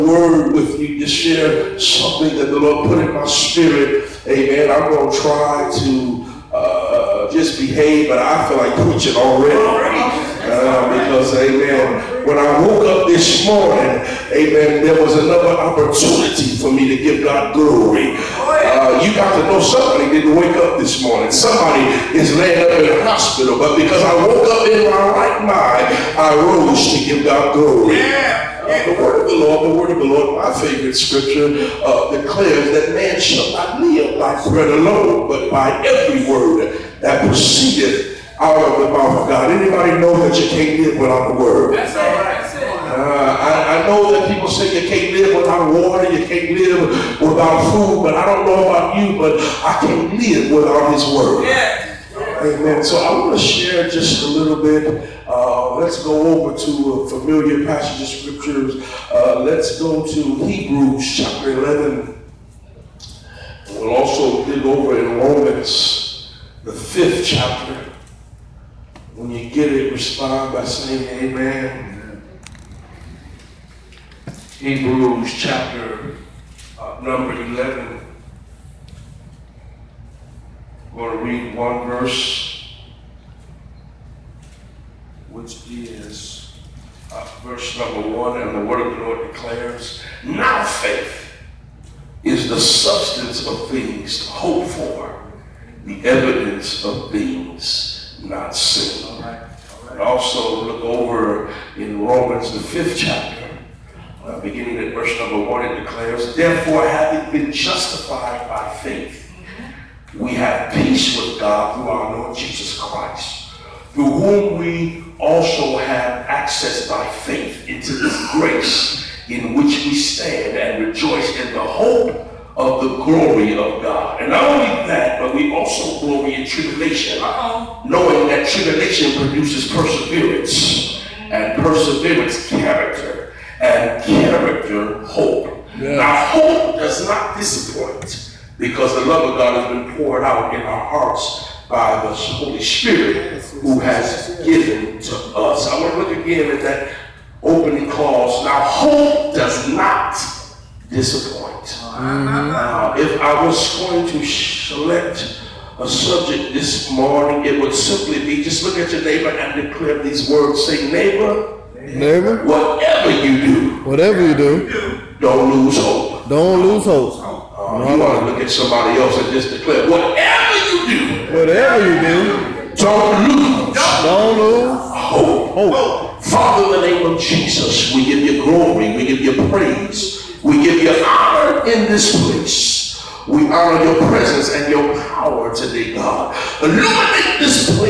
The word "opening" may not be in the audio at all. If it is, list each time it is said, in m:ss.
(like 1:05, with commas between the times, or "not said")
2:27.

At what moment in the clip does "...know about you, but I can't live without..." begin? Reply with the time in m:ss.
0:48.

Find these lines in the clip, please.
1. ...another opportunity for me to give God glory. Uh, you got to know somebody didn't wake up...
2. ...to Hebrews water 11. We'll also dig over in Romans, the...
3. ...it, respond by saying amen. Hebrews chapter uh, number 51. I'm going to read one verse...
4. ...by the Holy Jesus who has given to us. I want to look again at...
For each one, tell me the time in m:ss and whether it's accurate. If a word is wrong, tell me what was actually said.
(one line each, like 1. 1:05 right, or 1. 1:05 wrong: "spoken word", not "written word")
1. 0:15 right
2. 1:00 wrong: "chapter", not "water"
3. 1:09 wrong: "11", not "51"
4. 2:21 wrong: "Spirit", not "Jesus".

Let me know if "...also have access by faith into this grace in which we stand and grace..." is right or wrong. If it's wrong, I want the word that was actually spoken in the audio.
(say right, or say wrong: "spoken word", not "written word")
wrong: "rejoice", not "grace".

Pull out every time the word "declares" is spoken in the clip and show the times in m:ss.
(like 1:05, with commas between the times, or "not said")
0:32, 1:29, 1:45, 2:39, 2:49.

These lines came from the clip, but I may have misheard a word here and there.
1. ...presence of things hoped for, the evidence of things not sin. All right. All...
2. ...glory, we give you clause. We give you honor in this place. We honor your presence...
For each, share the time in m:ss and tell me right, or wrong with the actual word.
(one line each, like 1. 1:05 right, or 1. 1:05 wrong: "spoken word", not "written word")
1. 1:32 wrong: "substance", not "presence"
2. 2:58 wrong: "praise", not "clause".